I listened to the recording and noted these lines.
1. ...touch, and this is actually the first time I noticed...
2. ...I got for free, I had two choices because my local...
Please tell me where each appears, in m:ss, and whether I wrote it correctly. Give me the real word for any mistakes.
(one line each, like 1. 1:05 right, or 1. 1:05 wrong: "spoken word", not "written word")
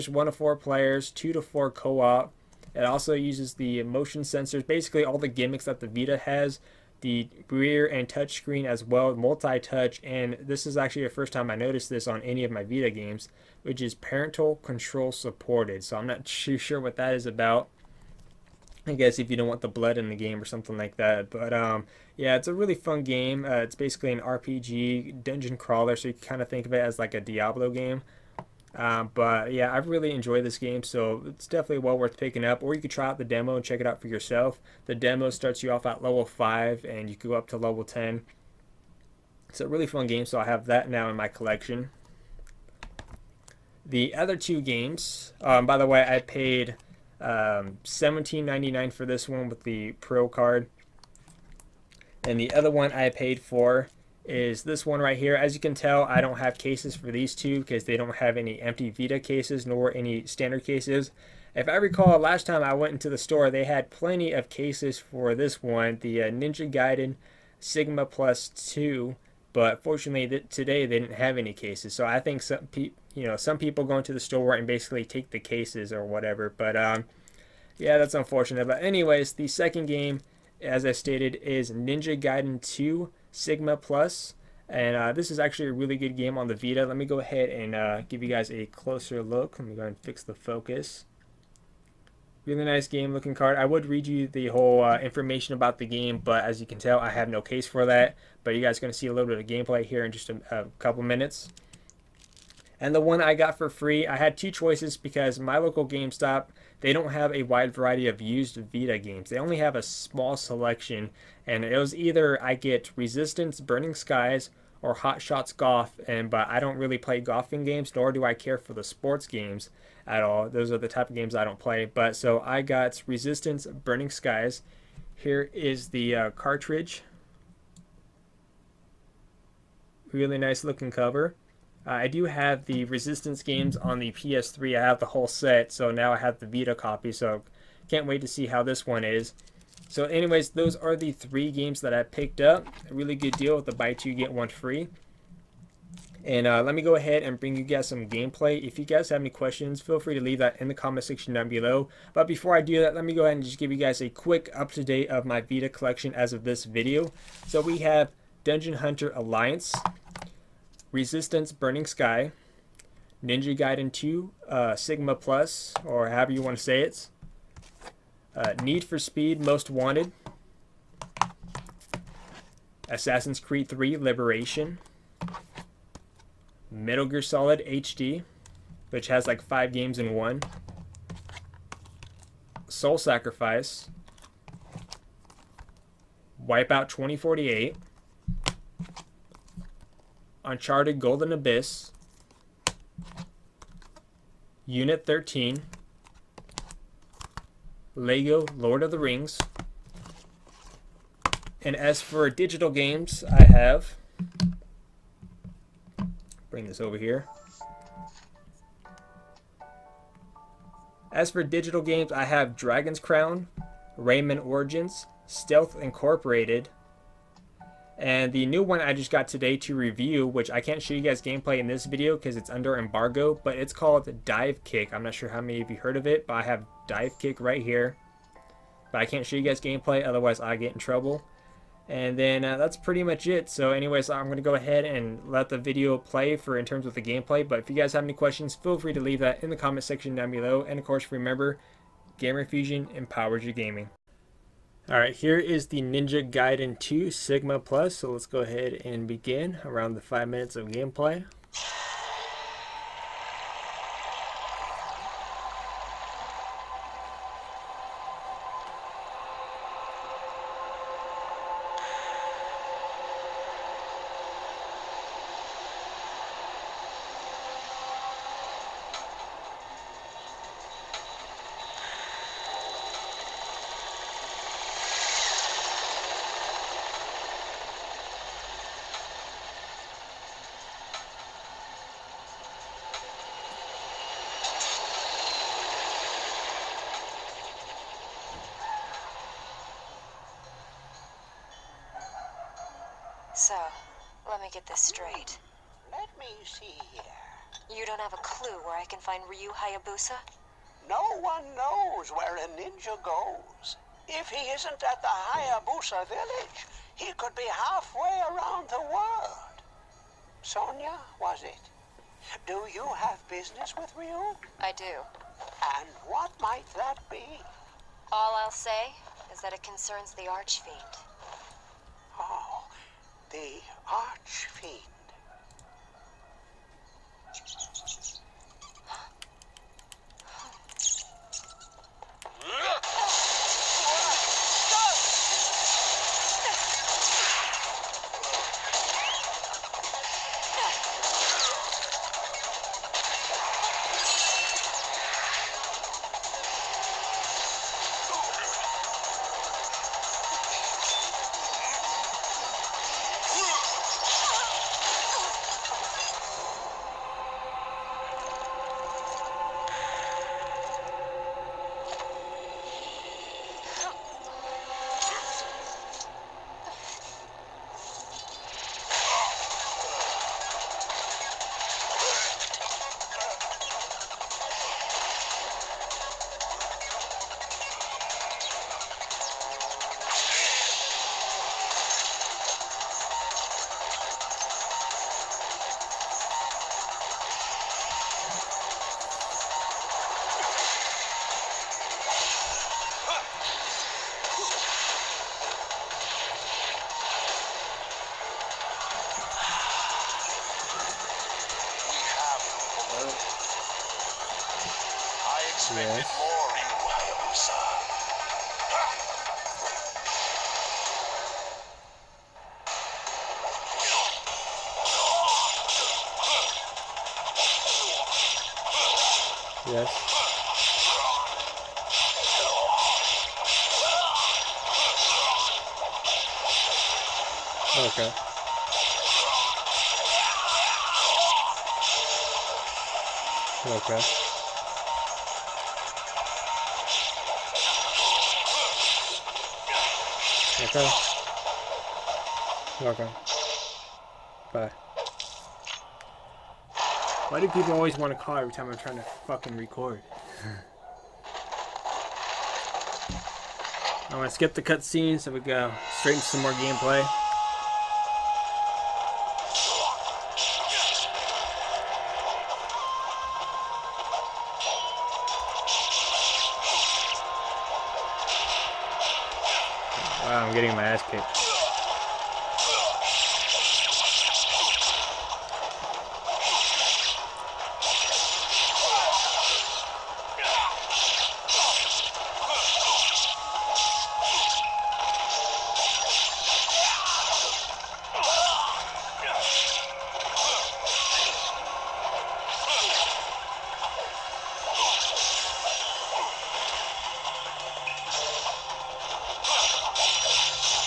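1. 0:09 right
2. 1:43 right.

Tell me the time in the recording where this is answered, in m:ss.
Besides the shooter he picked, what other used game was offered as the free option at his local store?
1:54.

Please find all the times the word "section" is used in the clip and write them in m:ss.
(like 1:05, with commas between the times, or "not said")
2:31, 3:59.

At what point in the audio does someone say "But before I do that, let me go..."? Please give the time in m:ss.
2:32.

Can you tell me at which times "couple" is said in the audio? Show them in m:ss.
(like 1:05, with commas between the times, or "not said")
1:40.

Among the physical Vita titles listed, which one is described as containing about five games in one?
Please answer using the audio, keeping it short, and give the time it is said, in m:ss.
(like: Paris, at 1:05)
Metal Gear Solid HD, at 2:56.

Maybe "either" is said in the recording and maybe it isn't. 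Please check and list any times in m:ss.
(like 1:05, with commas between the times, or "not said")
1:51.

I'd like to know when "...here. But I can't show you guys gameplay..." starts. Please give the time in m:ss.
3:47.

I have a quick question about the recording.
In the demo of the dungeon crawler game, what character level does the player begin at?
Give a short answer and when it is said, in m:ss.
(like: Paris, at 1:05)
5, at 0:36.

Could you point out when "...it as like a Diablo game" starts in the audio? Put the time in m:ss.
0:26.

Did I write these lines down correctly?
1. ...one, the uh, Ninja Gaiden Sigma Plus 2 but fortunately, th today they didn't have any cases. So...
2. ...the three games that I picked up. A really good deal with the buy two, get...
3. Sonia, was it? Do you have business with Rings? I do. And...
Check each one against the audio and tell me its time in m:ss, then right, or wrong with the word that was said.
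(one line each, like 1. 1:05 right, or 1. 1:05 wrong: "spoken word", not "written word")
1. 1:05 right
2. 2:20 right
3. 5:10 wrong: "Ryu", not "Rings".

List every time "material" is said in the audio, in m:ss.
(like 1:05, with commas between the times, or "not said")
not said.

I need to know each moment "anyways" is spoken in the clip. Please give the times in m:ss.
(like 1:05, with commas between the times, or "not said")
1:18, 2:20, 3:53.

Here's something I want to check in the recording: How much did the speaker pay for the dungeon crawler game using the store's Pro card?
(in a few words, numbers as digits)
$17.99.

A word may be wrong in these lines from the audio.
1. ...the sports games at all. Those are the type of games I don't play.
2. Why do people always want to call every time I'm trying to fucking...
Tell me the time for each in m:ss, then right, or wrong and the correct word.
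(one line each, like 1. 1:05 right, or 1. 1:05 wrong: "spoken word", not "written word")
1. 1:58 right
2. 7:27 right.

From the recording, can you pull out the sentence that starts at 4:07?
So let's go ahead and begin around the 5 minutes of gameplay.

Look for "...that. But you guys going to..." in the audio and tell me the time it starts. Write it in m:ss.
1:37.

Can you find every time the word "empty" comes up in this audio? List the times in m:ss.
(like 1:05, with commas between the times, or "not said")
0:58.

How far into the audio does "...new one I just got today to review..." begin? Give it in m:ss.
3:38.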